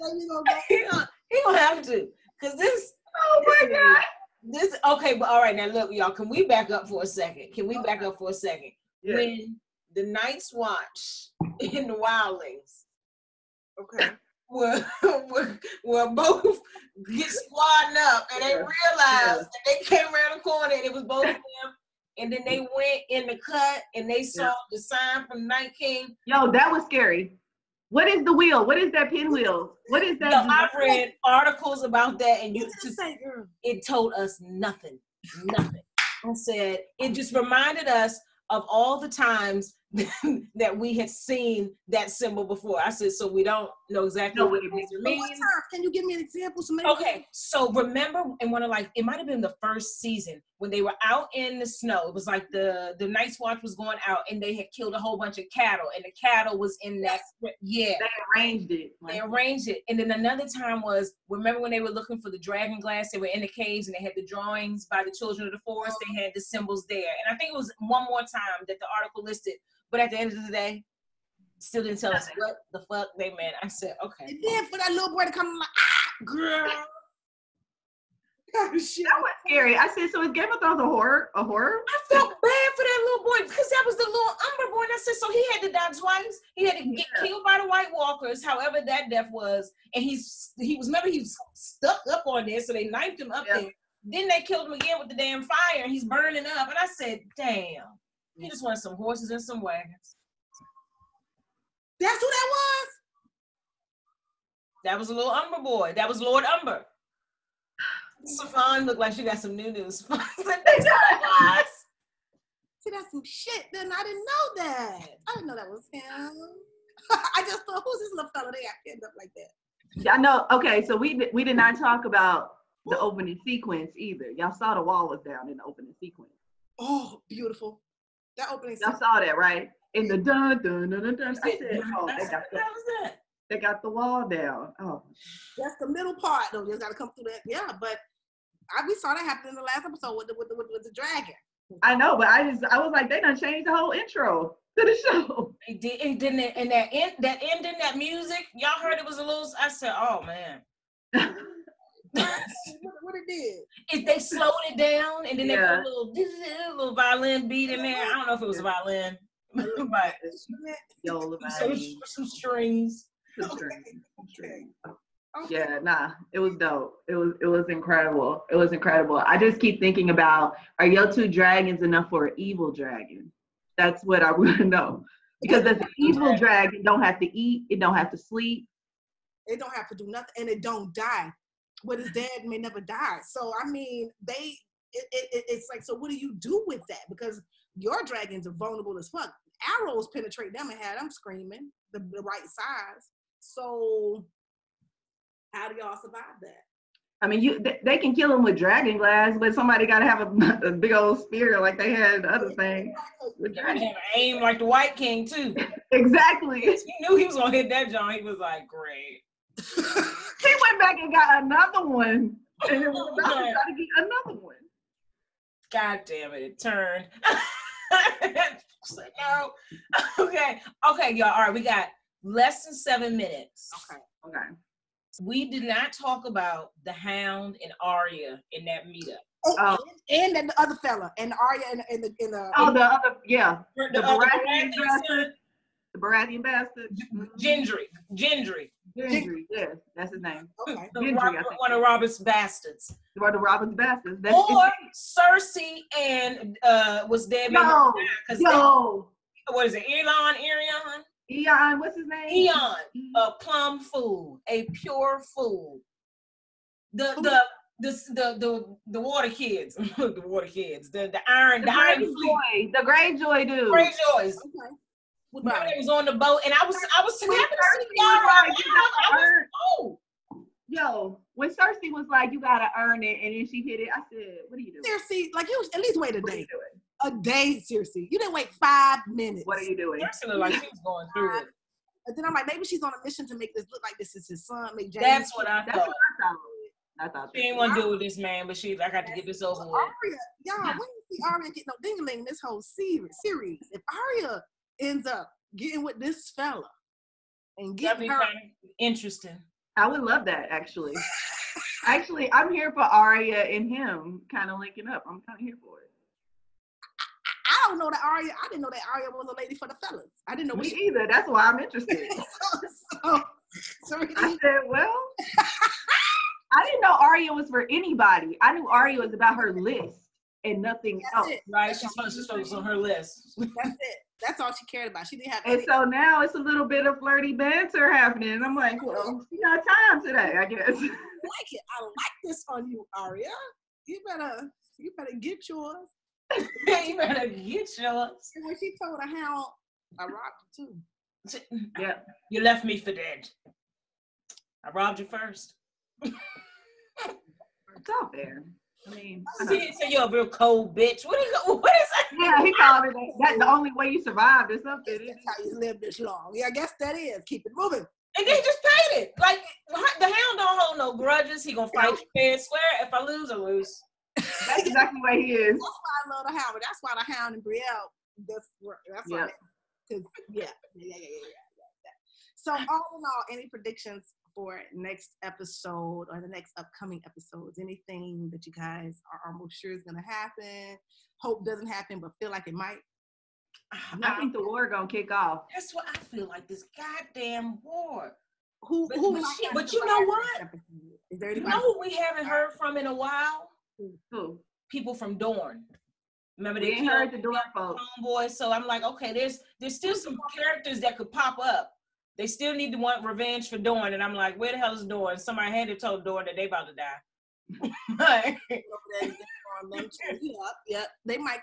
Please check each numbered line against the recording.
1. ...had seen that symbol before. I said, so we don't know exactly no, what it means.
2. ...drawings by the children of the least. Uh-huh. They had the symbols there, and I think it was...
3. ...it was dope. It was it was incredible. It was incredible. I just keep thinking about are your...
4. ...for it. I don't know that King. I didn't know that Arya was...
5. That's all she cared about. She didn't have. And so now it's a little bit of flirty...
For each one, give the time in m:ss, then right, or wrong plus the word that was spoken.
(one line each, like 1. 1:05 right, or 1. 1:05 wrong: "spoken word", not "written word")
1. 0:40 right
2. 1:04 wrong: "forest", not "least"
3. 2:46 right
4. 5:05 wrong: "Arya", not "King"
5. 5:24 right.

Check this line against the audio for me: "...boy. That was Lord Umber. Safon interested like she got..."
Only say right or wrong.
wrong.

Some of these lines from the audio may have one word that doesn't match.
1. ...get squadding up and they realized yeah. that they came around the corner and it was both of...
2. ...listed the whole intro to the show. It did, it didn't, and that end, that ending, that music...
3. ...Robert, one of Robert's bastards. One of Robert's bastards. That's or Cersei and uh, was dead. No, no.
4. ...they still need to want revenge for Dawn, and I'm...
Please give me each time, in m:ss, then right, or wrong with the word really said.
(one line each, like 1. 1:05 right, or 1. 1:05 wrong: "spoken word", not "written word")
1. 0:17 right
2. 2:23 wrong: "changed", not "listed"
3. 4:01 right
4. 6:42 right.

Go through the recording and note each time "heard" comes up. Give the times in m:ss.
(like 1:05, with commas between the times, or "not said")
2:28, 6:32, 6:36.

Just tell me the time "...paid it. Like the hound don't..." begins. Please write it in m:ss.
5:58.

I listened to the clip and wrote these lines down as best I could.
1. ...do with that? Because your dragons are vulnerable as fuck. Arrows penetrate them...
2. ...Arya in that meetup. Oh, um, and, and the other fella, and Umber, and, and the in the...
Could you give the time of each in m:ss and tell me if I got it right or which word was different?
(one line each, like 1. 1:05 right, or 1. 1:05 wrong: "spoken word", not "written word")
1. 3:06 right
2. 3:47 wrong: "Arya", not "Umber".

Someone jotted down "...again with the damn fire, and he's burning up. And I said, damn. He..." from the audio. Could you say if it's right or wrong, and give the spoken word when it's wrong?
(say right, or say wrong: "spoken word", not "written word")
right.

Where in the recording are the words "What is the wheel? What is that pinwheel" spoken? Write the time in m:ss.
0:27.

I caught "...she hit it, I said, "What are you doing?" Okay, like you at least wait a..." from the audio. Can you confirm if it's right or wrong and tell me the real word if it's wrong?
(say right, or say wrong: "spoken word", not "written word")
wrong: "Cersei", not "Okay".